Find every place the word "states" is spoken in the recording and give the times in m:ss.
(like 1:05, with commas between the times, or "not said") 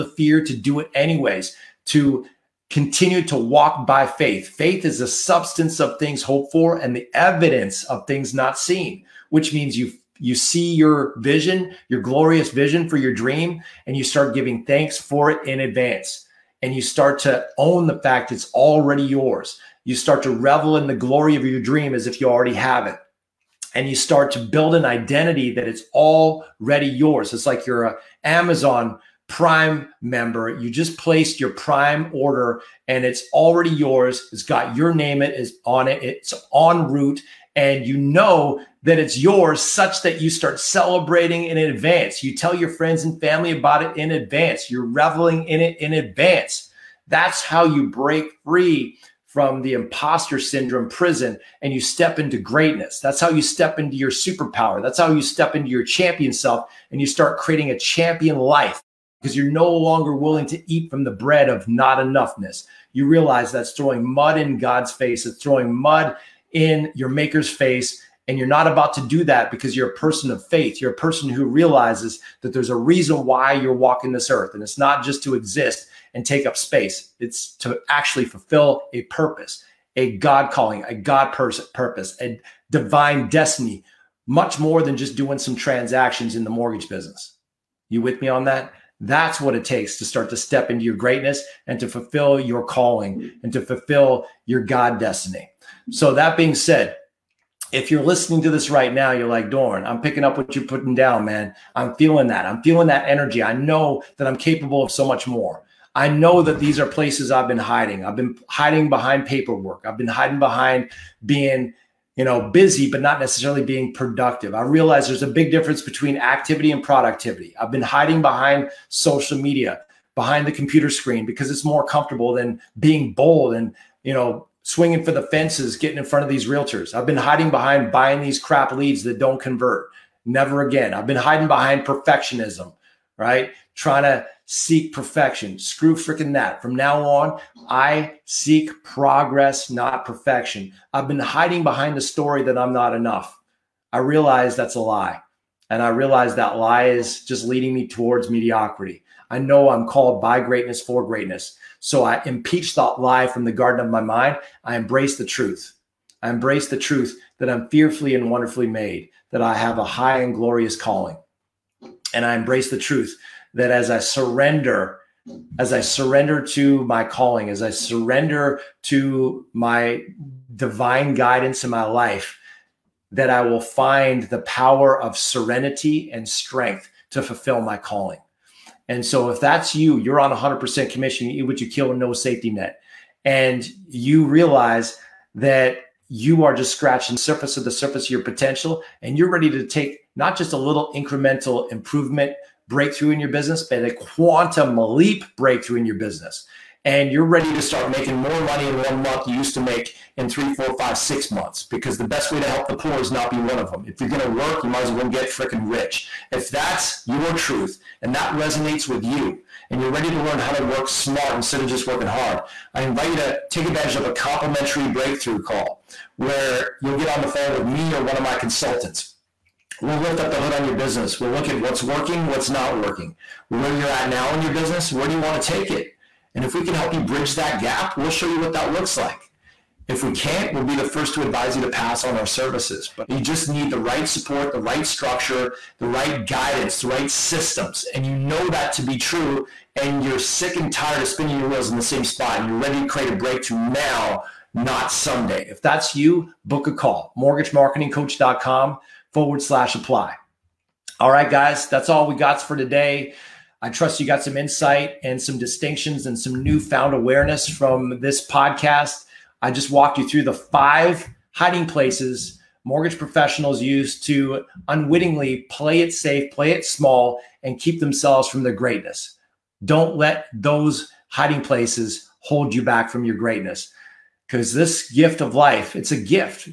not said.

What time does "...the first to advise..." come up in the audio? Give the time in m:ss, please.
3:50.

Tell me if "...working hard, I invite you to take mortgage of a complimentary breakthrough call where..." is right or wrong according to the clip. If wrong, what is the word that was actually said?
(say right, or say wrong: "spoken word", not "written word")
wrong: "advantage", not "mortgage".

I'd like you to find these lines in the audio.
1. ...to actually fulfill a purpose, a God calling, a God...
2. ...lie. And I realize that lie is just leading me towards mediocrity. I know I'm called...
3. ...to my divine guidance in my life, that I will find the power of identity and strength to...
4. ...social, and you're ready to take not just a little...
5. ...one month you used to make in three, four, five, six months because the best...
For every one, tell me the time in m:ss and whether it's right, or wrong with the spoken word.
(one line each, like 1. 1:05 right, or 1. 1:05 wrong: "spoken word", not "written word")
1. 1:17 right
2. 2:24 right
3. 2:48 wrong: "serenity", not "identity"
4. 3:08 wrong: "potential", not "social"
5. 3:18 right.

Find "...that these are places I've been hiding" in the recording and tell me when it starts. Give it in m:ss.
1:46.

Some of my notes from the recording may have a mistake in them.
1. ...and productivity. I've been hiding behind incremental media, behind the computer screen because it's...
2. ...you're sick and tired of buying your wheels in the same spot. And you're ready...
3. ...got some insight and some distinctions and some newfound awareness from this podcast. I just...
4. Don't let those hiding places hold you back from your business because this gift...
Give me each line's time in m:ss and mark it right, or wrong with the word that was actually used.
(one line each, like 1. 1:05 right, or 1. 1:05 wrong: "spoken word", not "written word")
1. 1:56 wrong: "social", not "incremental"
2. 4:00 wrong: "spinning", not "buying"
3. 4:14 right
4. 4:29 wrong: "greatness", not "business".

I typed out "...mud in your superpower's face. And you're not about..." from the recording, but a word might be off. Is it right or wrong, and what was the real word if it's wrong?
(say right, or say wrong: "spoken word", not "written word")
wrong: "maker", not "superpower".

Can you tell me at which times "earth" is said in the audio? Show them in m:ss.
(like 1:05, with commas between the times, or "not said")
1:14.